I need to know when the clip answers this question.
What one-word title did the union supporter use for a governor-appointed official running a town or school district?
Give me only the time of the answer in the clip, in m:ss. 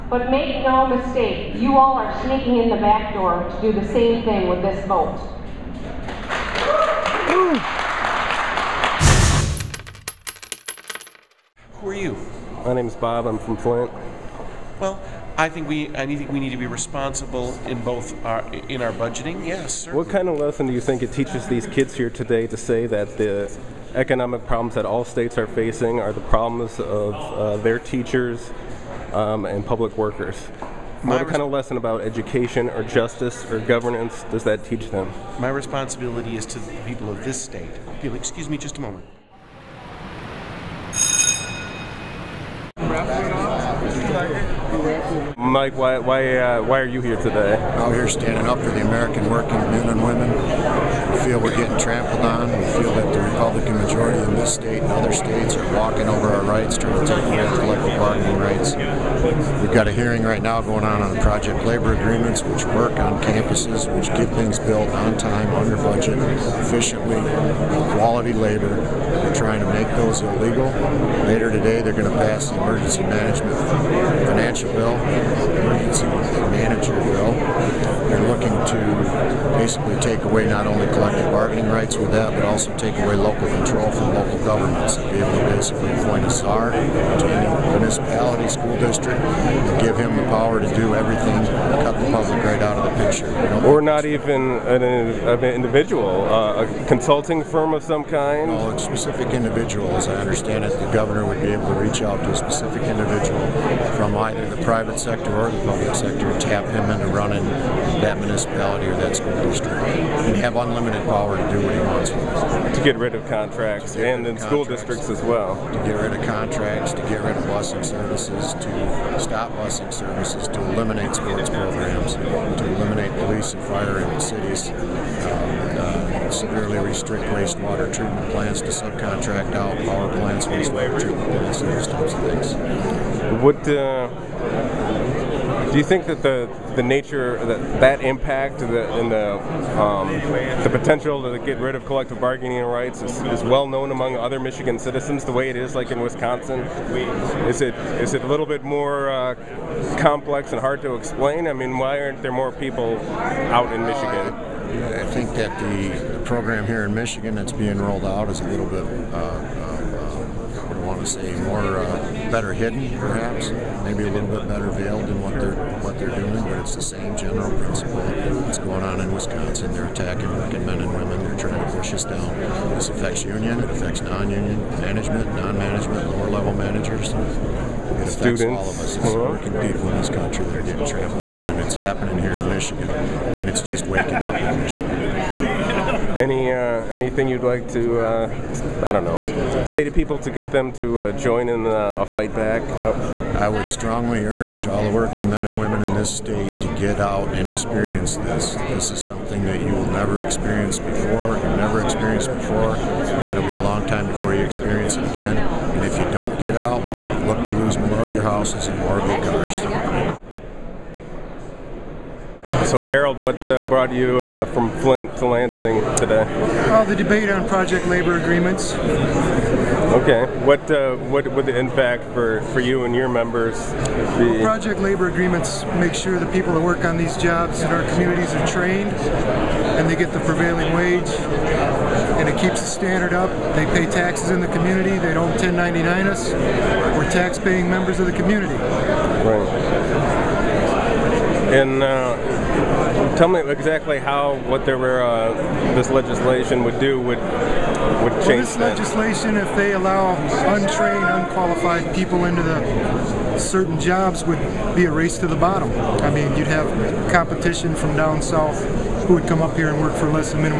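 1:26.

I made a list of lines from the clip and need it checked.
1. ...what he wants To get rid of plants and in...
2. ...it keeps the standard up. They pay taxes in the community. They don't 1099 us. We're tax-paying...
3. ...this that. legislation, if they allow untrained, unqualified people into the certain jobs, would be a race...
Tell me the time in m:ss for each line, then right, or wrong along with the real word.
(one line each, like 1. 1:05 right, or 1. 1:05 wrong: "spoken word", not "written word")
1. 1:51 wrong: "contracts", not "plants"
2. 3:52 right
3. 4:08 right.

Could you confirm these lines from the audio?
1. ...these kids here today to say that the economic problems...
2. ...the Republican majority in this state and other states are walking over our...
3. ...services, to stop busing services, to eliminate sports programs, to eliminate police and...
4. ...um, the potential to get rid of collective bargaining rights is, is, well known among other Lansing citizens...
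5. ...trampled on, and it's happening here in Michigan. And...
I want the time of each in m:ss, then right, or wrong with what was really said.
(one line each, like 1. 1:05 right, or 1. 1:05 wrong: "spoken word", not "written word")
1. 0:21 right
2. 0:53 right
3. 1:57 right
4. 2:19 wrong: "Michigan", not "Lansing"
5. 3:00 right.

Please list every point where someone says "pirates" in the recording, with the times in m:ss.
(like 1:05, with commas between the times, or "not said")
not said.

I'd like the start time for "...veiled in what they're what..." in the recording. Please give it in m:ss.
2:44.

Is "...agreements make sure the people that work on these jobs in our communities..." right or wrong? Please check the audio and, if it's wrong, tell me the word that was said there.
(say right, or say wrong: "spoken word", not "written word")
right.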